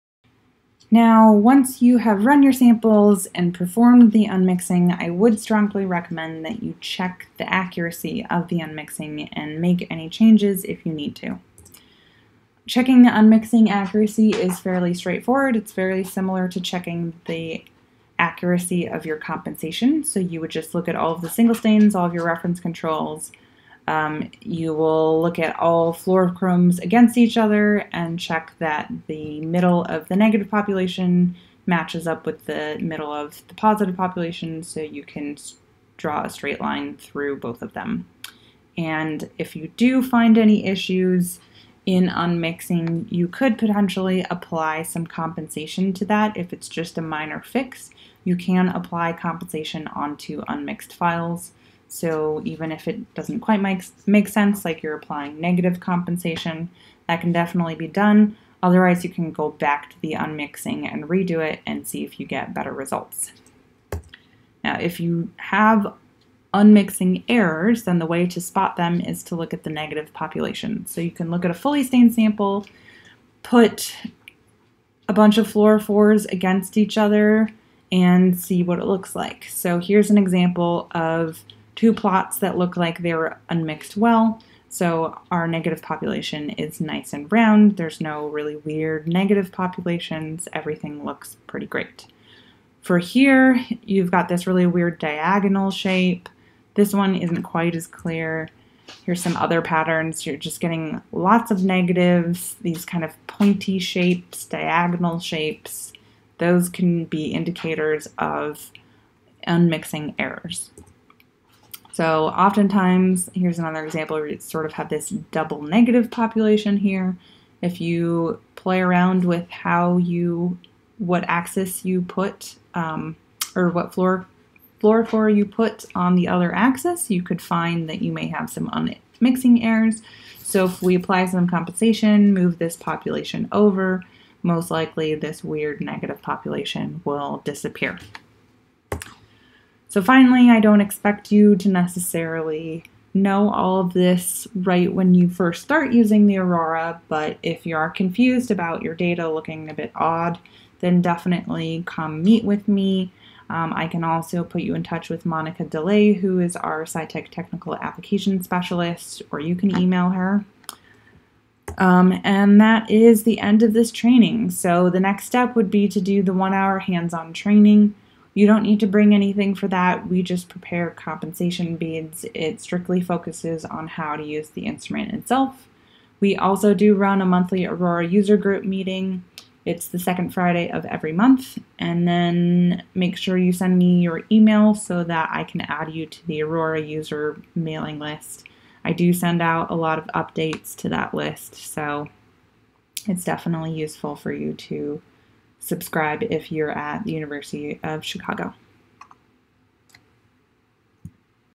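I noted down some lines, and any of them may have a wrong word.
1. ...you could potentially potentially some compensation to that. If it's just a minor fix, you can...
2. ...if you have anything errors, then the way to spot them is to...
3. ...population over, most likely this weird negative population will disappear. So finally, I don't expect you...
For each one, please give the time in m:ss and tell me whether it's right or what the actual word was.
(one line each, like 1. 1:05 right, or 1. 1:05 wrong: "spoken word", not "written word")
1. 0:43 wrong: "apply", not "potentially"
2. 1:04 wrong: "unmixing", not "anything"
3. 2:12 right.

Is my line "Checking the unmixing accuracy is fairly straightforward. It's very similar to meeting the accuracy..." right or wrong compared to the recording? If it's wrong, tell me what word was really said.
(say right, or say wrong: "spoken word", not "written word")
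wrong: "checking", not "meeting".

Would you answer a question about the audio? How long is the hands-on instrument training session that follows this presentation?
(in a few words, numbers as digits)
1 hour.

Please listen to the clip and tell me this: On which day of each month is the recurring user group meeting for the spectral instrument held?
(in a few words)
Second Friday.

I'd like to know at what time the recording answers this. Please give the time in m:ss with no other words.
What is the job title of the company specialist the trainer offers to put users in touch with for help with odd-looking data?
2:36.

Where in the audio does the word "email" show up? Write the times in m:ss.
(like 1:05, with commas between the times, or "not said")
2:39, 3:04.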